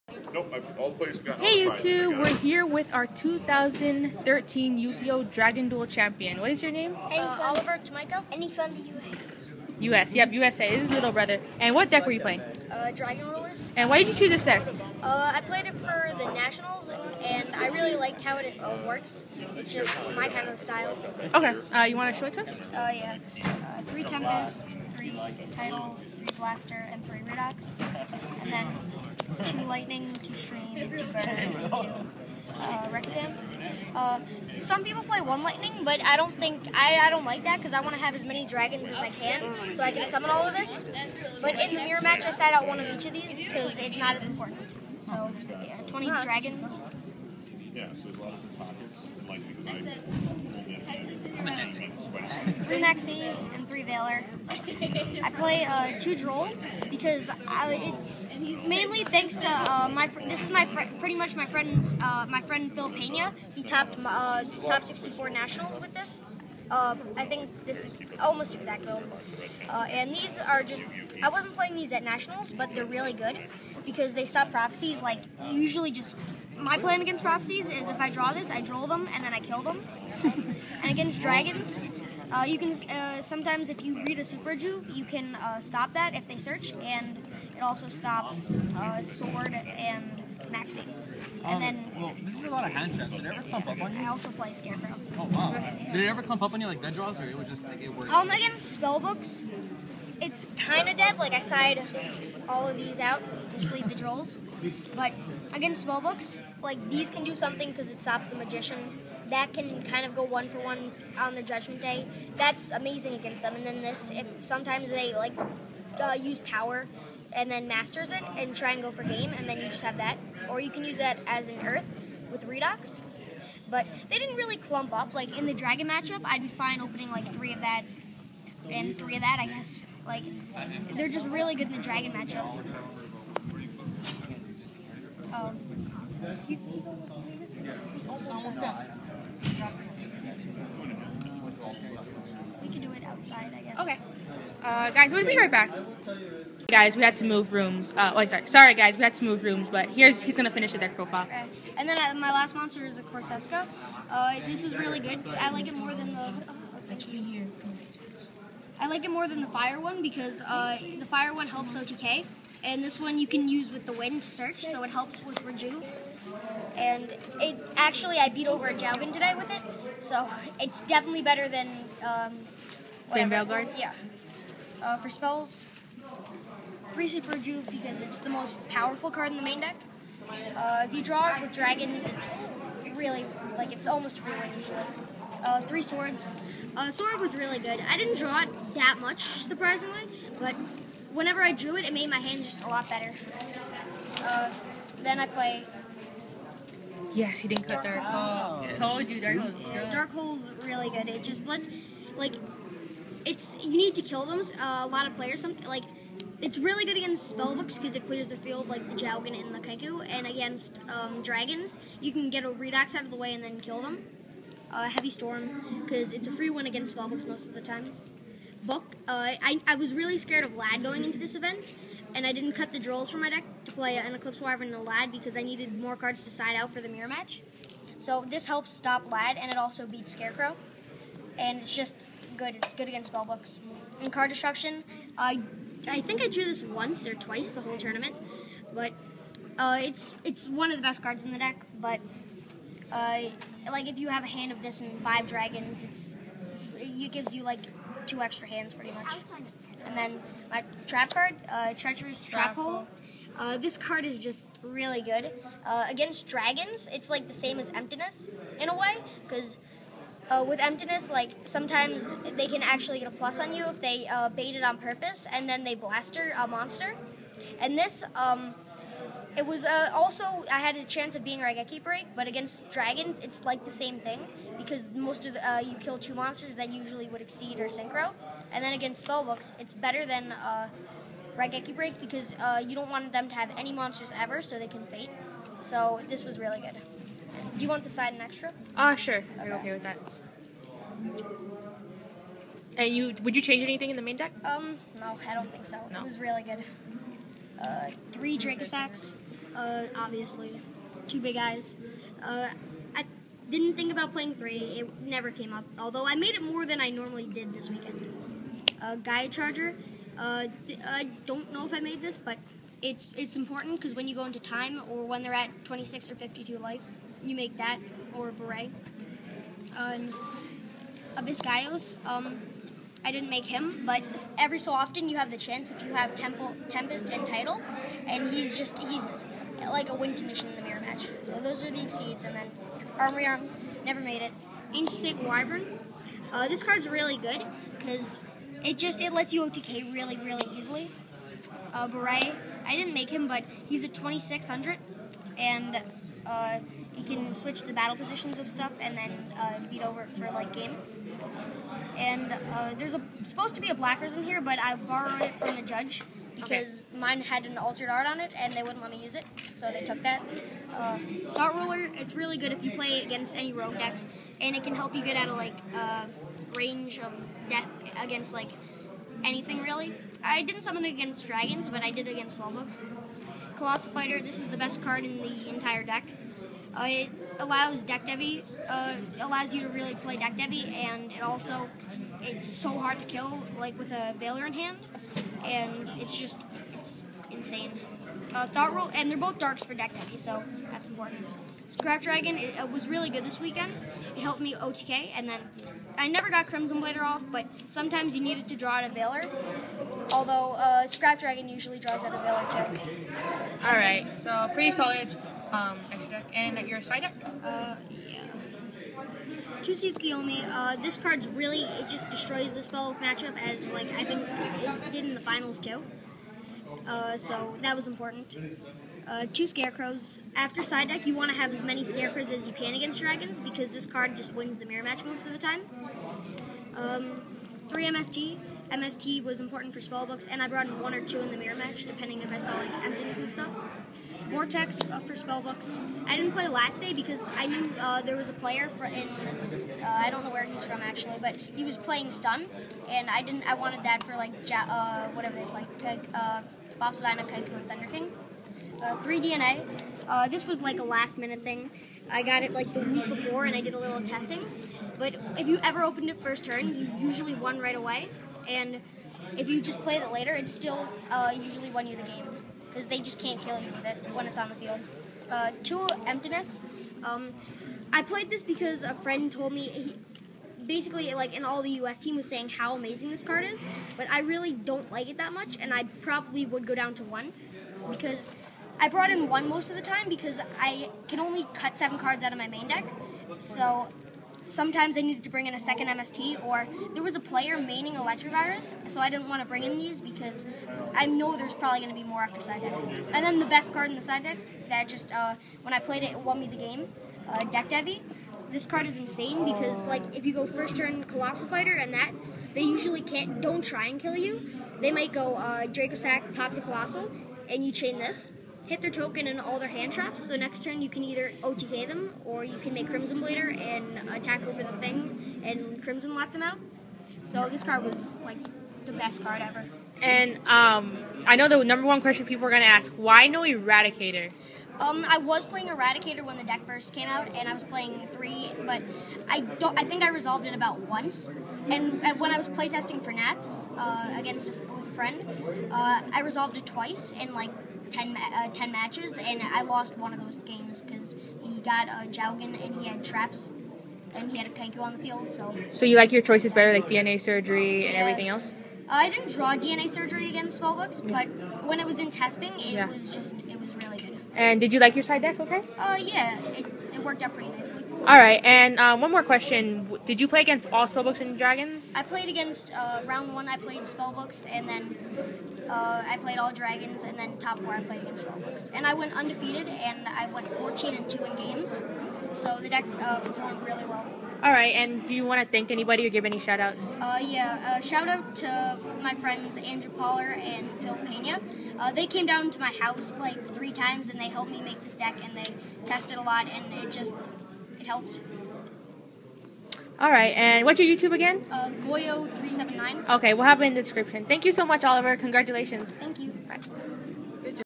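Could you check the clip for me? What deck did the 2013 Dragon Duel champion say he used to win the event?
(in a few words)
Dragon Rulers.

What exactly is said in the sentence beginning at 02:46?
And it actually, I beat over a Jowgen today with it, so it's definitely better than um, Flame Yeah.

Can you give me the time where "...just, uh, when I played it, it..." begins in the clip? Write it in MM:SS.
08:14.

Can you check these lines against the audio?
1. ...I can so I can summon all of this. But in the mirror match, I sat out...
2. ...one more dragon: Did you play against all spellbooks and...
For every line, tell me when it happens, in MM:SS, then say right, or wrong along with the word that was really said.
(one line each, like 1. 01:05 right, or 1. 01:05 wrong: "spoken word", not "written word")
1. 00:38 right
2. 09:18 wrong: "question", not "dragon".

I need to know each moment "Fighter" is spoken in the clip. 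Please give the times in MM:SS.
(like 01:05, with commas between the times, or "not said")
06:13, 08:21.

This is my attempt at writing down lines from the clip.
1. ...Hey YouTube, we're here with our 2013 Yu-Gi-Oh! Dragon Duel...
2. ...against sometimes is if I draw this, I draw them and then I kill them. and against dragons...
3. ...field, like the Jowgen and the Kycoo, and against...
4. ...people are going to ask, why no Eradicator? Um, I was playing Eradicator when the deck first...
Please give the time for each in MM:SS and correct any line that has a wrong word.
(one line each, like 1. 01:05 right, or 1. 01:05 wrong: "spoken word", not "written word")
1. 00:01 right
2. 01:17 wrong: "prophecies", not "sometimes"
3. 03:28 right
4. 08:42 right.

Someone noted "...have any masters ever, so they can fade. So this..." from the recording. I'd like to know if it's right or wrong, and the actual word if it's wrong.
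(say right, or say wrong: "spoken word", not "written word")
wrong: "monsters", not "masters".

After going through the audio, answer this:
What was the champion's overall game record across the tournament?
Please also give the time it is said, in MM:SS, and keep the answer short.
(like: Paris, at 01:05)
14 and 2, at 09:30.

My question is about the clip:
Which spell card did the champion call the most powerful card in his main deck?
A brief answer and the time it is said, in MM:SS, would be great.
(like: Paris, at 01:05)
Reset, at 02:56.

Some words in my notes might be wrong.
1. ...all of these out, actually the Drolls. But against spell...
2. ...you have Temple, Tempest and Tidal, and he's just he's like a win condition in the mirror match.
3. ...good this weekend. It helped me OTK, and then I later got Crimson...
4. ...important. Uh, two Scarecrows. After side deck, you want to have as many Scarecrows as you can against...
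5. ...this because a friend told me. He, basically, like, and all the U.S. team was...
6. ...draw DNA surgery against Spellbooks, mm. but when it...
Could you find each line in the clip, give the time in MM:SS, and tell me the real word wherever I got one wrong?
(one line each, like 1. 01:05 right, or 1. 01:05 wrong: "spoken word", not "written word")
1. 01:42 right
2. 05:25 right
3. 06:33 wrong: "never", not "later"
4. 06:57 right
5. 07:48 right
6. 09:09 right.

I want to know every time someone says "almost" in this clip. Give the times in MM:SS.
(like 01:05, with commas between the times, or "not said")
01:08, 03:03.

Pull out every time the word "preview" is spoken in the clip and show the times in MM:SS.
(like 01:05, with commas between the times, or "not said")
not said.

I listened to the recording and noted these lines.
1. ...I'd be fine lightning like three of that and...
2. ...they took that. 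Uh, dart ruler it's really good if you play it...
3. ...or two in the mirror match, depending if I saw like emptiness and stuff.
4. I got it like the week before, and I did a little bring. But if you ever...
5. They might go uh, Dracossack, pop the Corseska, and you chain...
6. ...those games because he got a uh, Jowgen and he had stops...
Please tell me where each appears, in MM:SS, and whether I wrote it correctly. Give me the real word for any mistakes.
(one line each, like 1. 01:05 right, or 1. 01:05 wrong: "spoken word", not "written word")
1. 02:06 wrong: "opening", not "lightning"
2. 05:59 right
3. 07:10 right
4. 07:32 wrong: "testing", not "bring"
5. 08:24 wrong: "Colossal", not "Corseska"
6. 09:00 wrong: "traps", not "stops".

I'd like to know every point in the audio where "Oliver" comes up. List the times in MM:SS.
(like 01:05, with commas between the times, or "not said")
00:07, 09:54.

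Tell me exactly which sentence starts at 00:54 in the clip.
I play uh, two Droll because I, uh, it's mainly thanks to uh, my.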